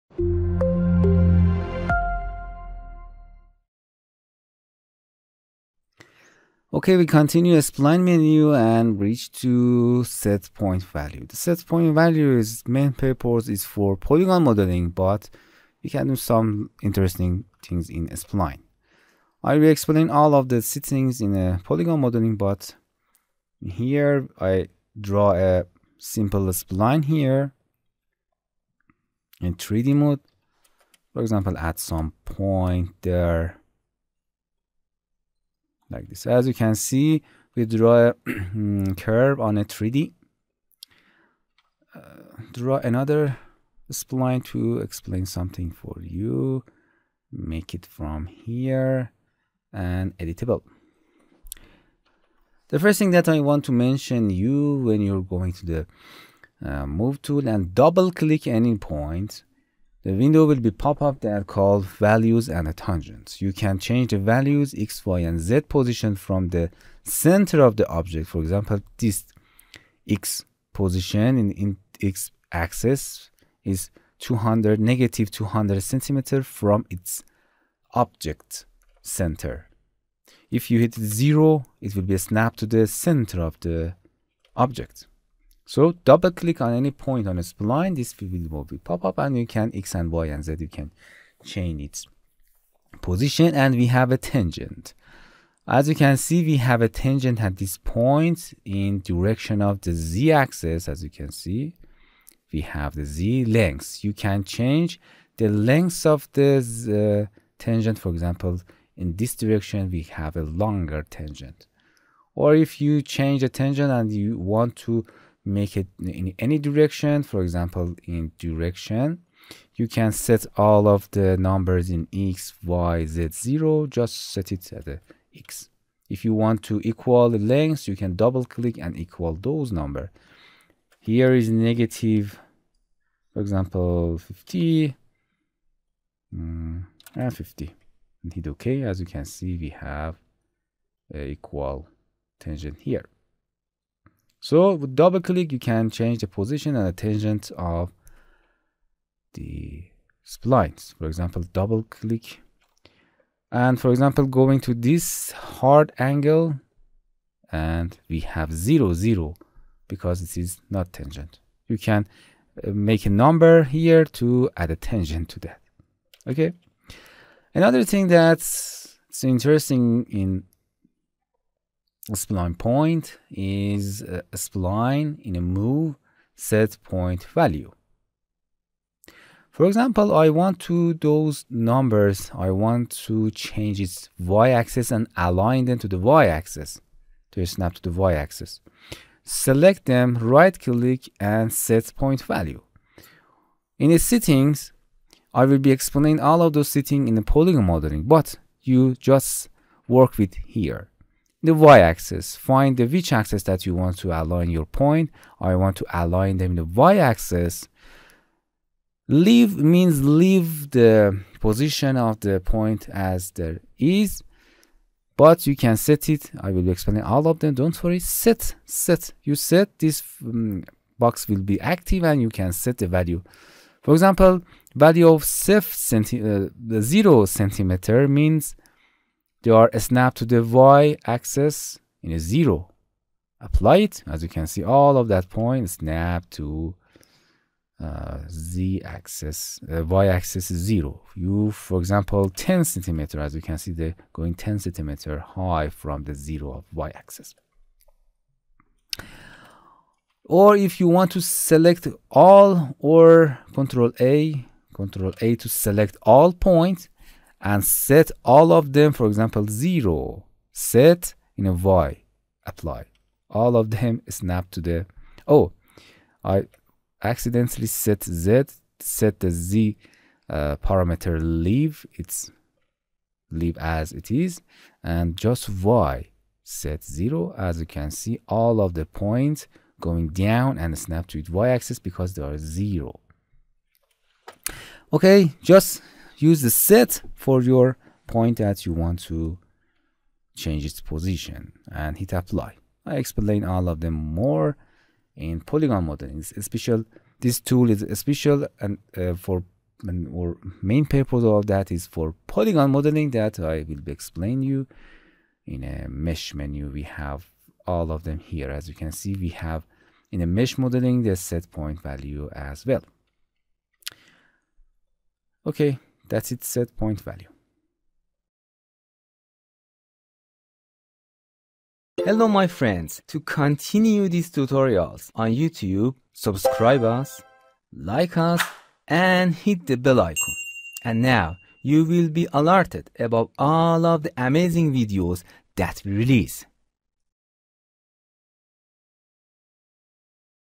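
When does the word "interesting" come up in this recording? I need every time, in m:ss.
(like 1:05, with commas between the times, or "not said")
0:16, 2:49.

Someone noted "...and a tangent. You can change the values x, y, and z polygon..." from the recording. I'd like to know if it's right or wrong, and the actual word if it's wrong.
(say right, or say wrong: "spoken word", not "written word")
wrong: "position", not "polygon".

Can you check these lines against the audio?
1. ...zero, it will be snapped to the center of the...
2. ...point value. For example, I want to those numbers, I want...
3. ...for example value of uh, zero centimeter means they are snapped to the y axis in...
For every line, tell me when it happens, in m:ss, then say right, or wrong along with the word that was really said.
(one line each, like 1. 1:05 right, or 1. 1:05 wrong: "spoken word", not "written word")
1. 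1:20 right
2. 2:56 right
3. 3:43 right.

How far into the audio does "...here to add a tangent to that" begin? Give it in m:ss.
2:43.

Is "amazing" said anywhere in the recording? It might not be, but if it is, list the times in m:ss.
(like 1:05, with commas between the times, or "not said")
5:34.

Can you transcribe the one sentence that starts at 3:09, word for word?
Select them, right-click and set point value.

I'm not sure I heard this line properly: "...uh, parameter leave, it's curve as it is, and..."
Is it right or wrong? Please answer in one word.
wrong.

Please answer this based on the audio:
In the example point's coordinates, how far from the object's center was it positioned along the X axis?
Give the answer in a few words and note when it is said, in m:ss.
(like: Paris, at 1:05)
-200 centimeters, at 1:14.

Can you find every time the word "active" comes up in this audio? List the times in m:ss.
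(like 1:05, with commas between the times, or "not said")
3:41.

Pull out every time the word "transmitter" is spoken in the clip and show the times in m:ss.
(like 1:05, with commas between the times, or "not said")
not said.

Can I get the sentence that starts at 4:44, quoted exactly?
Okay, just use the set for your point that you want to change its position and hit apply.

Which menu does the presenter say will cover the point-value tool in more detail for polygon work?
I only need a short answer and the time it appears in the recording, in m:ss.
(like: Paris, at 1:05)
Mesh menu, at 5:05.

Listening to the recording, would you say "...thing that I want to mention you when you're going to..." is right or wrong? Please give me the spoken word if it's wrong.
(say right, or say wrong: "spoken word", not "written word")
right.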